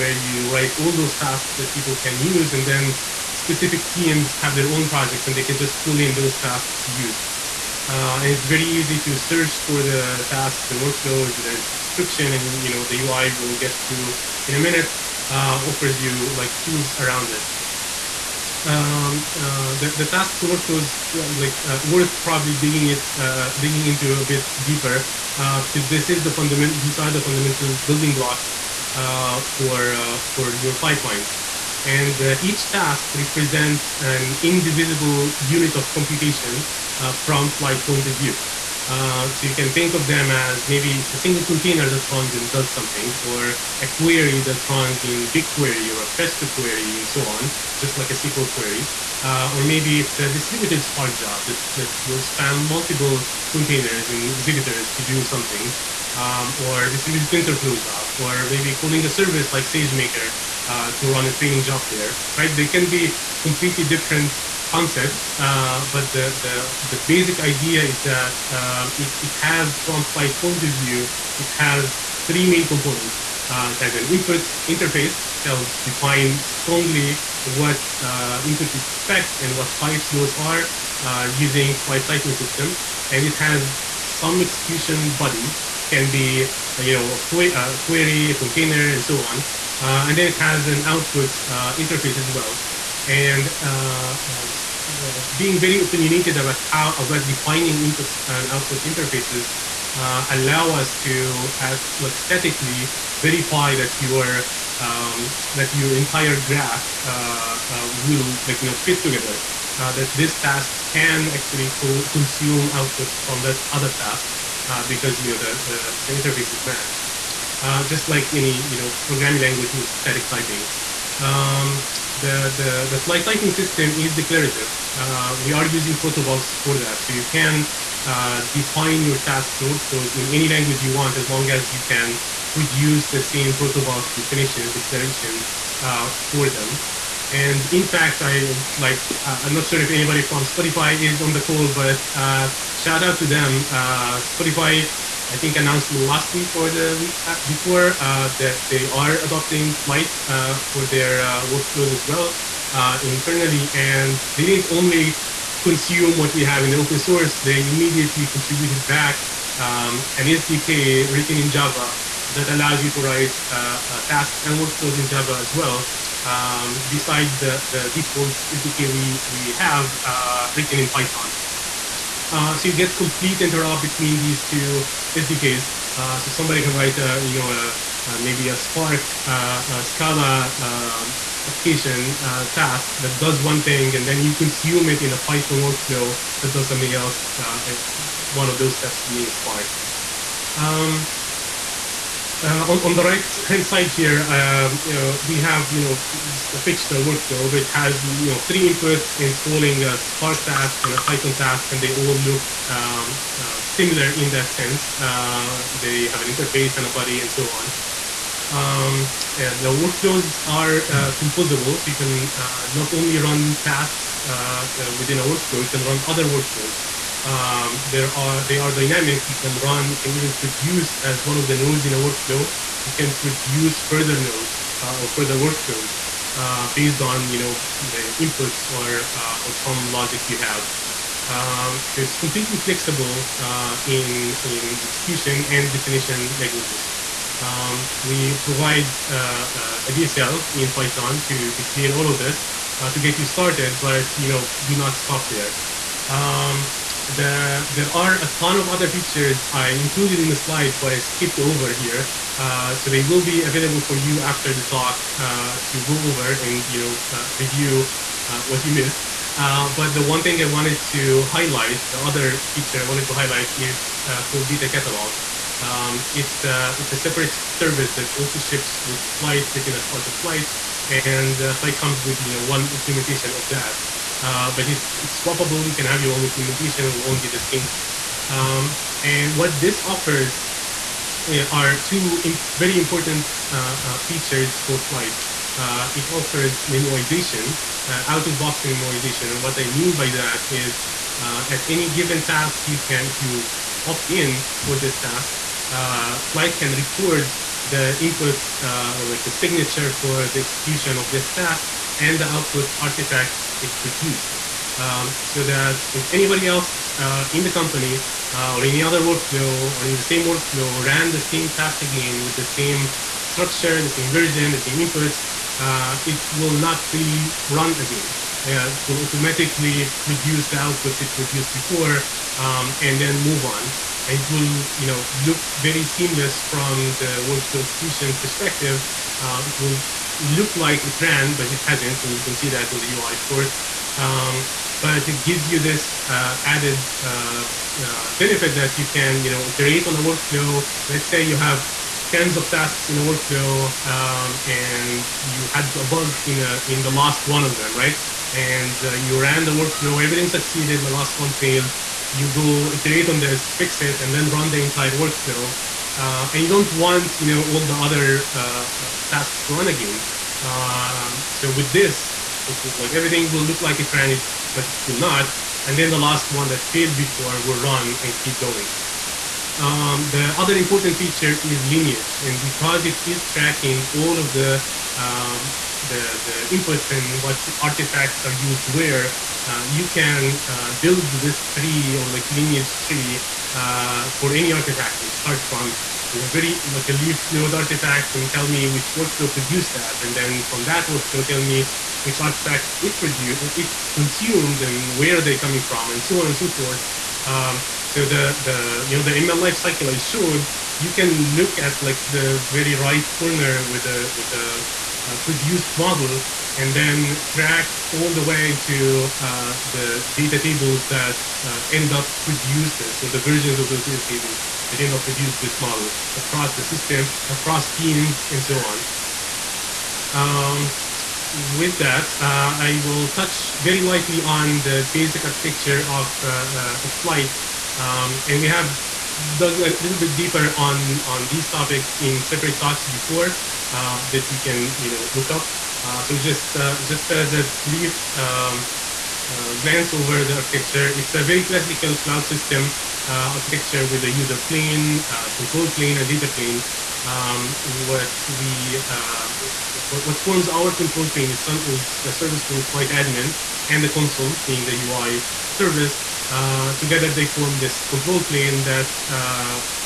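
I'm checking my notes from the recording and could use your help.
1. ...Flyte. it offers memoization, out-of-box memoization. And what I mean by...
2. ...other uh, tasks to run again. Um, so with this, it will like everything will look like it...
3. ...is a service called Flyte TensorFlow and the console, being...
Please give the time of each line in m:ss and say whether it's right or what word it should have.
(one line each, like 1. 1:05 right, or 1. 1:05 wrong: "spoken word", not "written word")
1. 4:44 right
2. 5:57 right
3. 7:31 wrong: "Admin", not "TensorFlow".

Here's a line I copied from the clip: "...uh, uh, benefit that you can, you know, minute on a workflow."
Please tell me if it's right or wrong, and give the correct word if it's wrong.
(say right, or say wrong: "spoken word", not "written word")
wrong: "iterate", not "minute".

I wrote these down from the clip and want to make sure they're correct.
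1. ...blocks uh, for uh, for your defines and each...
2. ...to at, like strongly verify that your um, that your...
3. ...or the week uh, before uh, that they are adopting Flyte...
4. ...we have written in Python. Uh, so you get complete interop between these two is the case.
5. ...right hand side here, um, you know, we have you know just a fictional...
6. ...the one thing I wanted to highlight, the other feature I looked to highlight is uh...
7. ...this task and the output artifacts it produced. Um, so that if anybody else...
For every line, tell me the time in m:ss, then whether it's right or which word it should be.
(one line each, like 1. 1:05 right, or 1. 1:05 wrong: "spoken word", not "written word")
1. 0:28 wrong: "pipelines", not "defines"
2. 1:40 wrong: "statically", not "strongly"
3. 2:26 right
4. 2:49 right
5. 3:13 right
6. 4:19 wrong: "wanted", not "looked"
7. 5:01 right.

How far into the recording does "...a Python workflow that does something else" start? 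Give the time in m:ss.
3:05.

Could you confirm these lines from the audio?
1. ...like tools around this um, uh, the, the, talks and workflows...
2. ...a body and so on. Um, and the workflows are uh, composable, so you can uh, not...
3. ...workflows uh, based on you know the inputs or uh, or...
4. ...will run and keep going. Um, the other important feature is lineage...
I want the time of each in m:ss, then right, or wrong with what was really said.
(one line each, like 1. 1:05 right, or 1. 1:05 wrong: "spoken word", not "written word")
1. 0:16 wrong: "tasks", not "talks"
2. 3:26 right
3. 3:45 right
4. 6:07 right.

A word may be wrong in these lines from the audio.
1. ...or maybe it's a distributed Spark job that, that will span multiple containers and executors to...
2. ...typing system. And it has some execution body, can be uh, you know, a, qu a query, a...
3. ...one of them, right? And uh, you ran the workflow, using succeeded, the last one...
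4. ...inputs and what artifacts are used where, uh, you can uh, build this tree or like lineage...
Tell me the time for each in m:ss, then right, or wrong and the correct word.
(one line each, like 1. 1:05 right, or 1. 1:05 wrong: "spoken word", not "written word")
1. 0:49 right
2. 1:22 right
3. 5:47 wrong: "everything", not "using"
4. 6:16 right.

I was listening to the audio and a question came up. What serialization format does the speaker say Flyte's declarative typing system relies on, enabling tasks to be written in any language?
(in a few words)
protobufs.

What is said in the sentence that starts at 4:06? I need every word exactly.
Um, the, there are a ton of other features I included in the slides, but I skipped over here.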